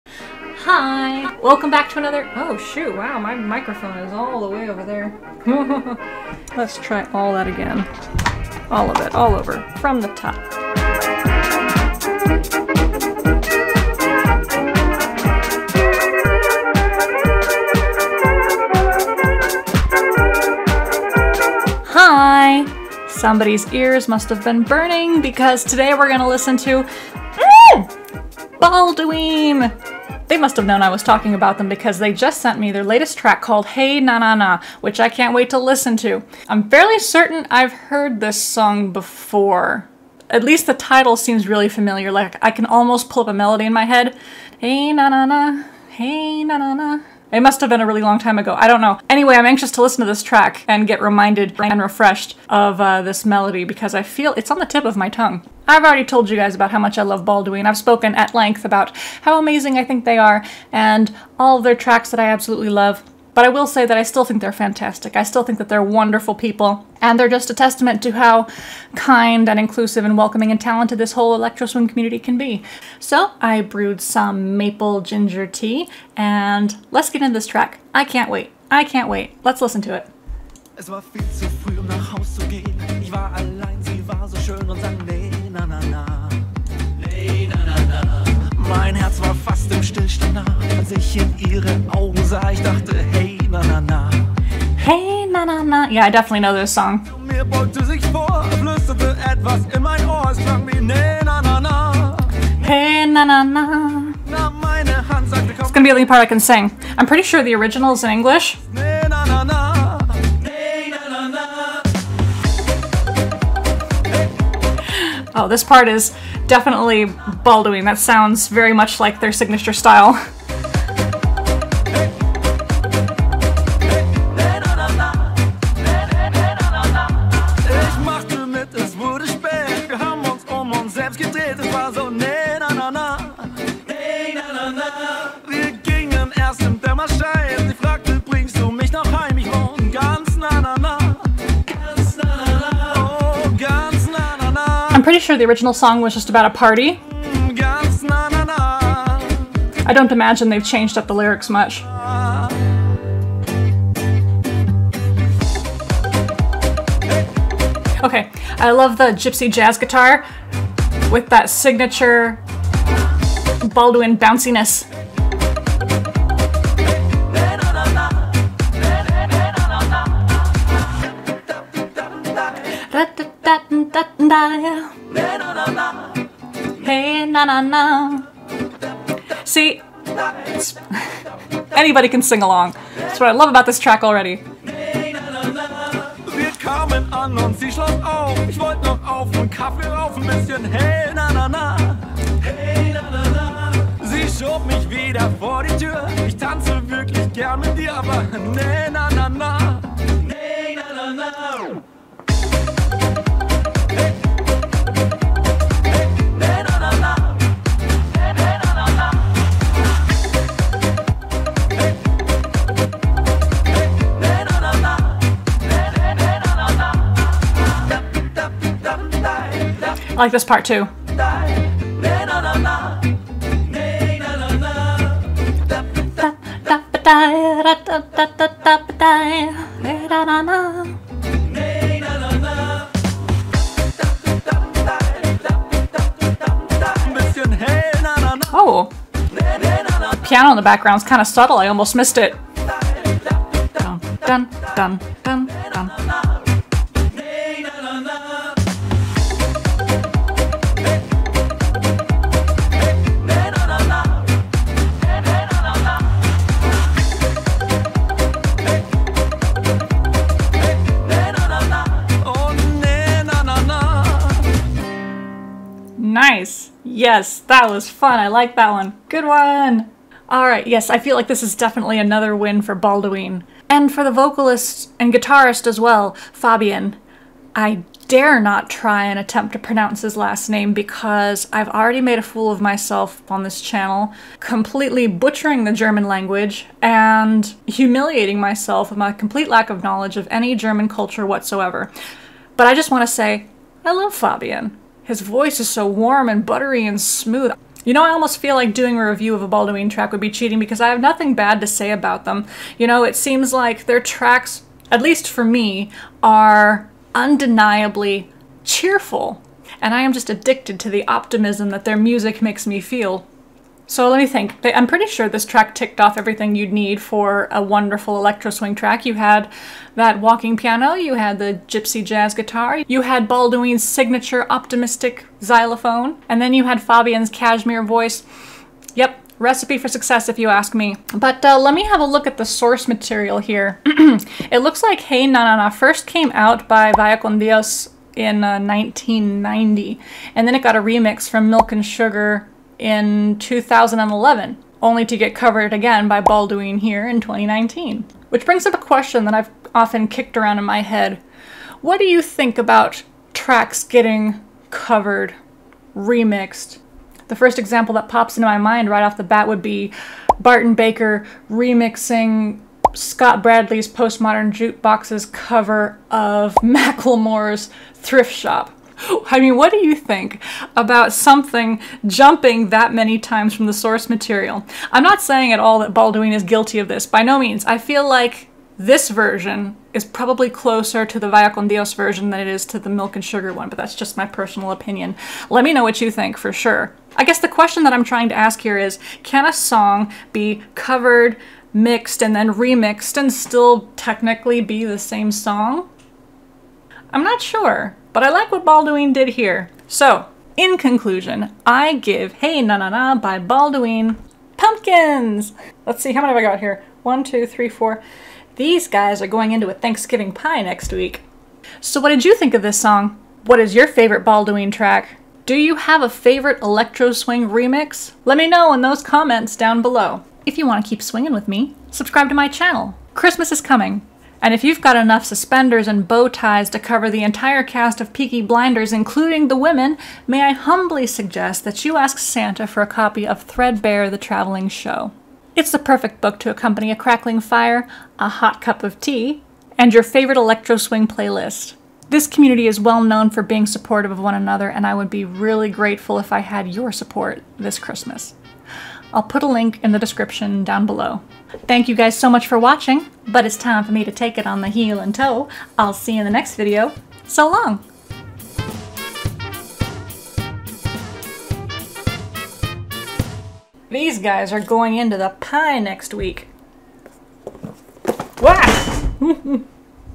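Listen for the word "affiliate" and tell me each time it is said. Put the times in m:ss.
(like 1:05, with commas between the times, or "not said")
not said.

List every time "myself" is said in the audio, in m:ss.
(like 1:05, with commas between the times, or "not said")
4:42, 4:48.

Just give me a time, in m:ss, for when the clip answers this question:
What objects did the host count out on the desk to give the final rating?
6:44.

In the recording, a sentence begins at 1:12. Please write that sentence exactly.
So I brewed some maple ginger tea, and let's get into this track.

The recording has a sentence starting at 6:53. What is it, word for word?
What is your favorite Balduin track?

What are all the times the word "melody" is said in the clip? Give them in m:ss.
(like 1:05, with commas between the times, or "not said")
0:43, 0:53.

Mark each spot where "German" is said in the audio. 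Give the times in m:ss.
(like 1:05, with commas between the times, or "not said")
4:45, 4:50.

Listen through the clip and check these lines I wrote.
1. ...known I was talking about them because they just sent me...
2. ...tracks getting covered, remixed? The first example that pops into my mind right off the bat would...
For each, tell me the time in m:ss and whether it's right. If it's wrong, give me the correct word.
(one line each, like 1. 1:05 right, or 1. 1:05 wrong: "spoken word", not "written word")
1. 0:30 right
2. 5:53 right.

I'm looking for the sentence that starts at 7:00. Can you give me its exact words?
If you want to keep swinging with me, subscribe to my channel.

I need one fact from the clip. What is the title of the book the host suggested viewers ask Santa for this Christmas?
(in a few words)
Threadbare the Traveling Show.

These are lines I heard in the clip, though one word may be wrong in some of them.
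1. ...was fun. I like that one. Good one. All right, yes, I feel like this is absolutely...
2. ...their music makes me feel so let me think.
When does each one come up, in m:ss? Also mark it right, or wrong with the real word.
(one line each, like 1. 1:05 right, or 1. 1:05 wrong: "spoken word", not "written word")
1. 4:27 wrong: "definitely", not "absolutely"
2. 5:11 right.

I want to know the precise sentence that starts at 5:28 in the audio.
Yep, recipe for success if you ask me.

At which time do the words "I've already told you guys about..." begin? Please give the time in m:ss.
0:55.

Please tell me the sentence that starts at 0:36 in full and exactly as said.
I'm fairly certain I've heard this song before.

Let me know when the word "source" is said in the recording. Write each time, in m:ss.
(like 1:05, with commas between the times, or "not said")
5:32, 6:13.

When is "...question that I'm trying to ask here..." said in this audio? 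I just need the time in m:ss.
6:27.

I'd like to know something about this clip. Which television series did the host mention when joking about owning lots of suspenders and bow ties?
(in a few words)
Peaky Blinders.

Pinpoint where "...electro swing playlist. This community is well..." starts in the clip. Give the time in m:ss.
7:20.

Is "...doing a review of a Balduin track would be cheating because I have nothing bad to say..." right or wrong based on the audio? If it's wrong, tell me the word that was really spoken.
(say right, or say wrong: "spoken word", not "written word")
right.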